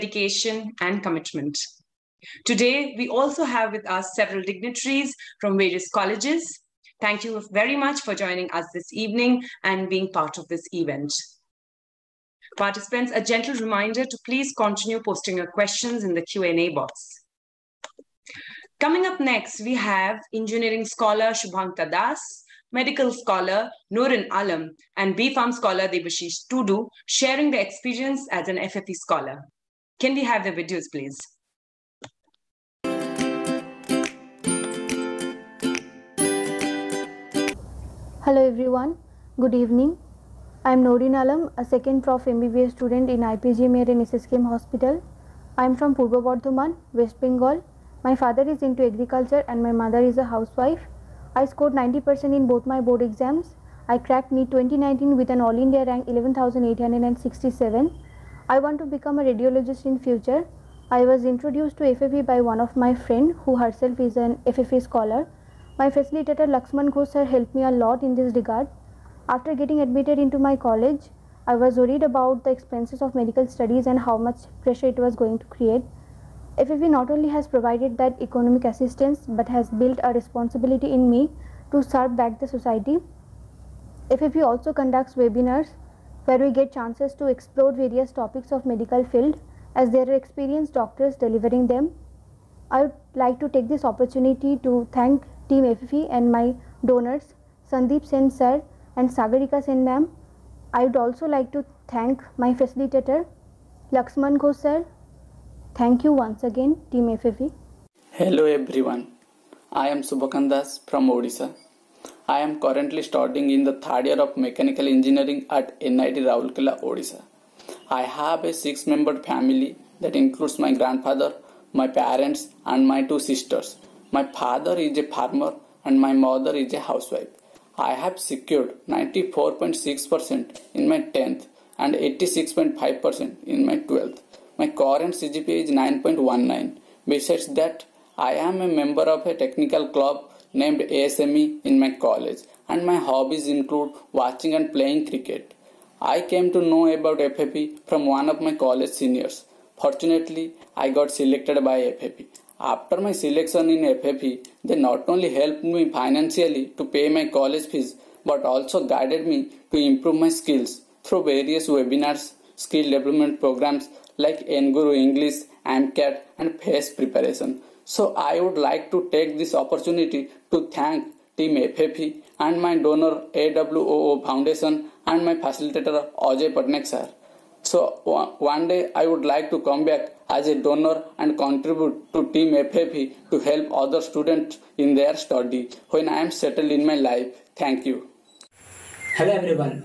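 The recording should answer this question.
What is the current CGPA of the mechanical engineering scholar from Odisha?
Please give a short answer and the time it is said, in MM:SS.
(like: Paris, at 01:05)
9.19, at 02:15.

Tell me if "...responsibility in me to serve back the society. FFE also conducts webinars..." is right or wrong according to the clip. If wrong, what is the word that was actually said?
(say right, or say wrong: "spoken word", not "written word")
right.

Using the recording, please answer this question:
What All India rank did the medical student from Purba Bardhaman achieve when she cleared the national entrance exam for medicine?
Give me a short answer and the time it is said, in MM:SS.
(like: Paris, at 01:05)
11,867, at 00:56.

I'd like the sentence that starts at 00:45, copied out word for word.
I am from Purba Bardhaman, West Bengal my father is into agriculture and my mother is a housewife.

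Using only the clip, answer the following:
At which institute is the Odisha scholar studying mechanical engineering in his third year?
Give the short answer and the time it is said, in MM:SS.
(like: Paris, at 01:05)
NIT Rourkela, at 01:55.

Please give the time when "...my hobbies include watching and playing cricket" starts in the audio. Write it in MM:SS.
02:22.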